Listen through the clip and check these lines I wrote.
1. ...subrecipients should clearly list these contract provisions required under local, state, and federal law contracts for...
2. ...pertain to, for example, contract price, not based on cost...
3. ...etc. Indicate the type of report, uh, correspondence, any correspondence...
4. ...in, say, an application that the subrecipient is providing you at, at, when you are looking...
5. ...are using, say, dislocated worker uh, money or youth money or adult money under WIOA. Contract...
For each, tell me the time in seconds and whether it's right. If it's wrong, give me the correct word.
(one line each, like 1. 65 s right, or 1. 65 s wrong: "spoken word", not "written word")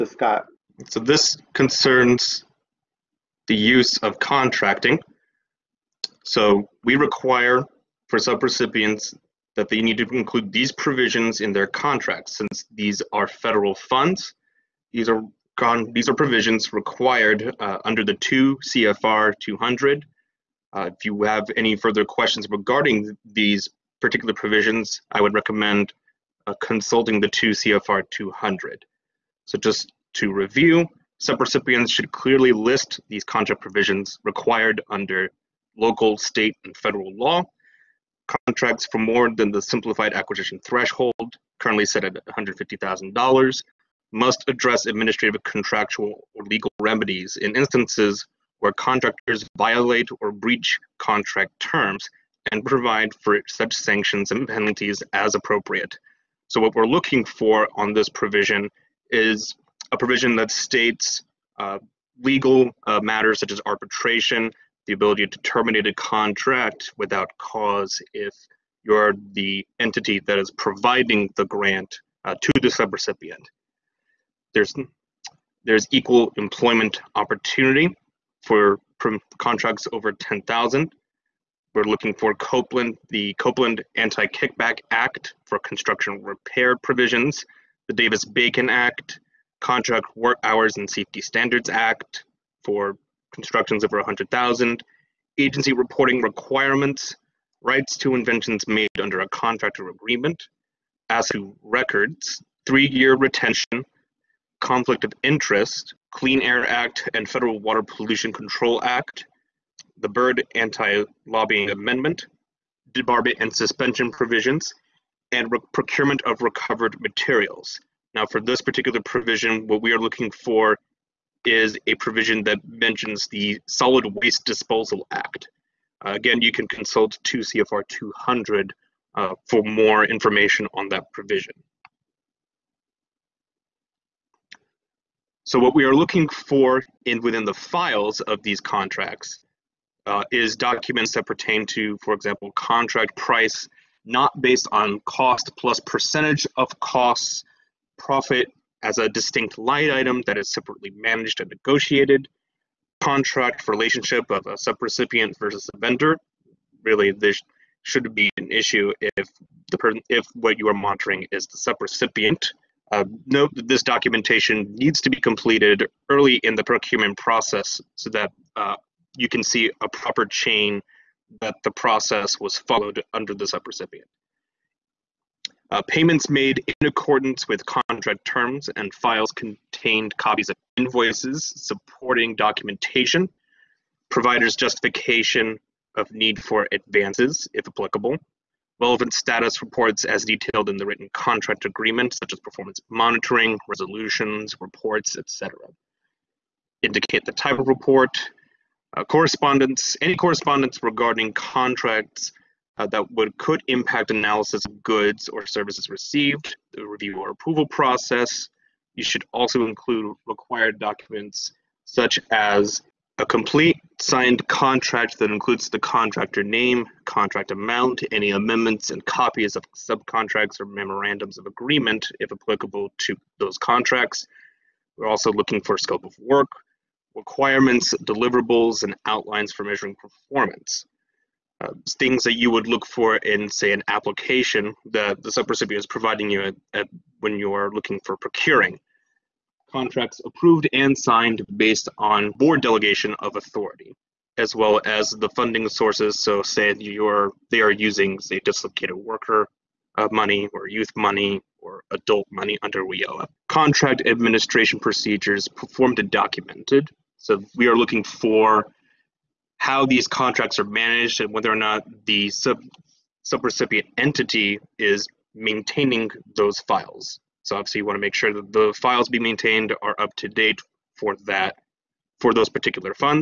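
1. 31 s right
2. 141 s right
3. 195 s right
4. 233 s right
5. 247 s right.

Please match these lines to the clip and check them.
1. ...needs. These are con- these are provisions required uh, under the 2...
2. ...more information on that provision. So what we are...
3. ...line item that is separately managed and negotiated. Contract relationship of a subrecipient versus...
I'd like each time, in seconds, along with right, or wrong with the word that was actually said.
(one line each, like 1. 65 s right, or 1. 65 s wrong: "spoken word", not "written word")
1. 13 s wrong: "funds", not "needs"
2. 129 s right
3. 149 s right.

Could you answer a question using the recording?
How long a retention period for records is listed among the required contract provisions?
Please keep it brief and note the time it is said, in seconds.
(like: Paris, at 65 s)
3 years, at 102 s.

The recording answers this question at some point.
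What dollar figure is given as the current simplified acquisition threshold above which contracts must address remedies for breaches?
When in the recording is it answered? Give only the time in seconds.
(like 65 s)
42 s.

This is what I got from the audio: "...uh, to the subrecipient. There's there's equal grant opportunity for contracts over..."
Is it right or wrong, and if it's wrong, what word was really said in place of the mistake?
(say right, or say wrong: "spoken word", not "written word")
wrong: "employment", not "grant".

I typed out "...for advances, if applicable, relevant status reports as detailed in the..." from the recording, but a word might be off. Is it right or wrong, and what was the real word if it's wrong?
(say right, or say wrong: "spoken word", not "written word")
right.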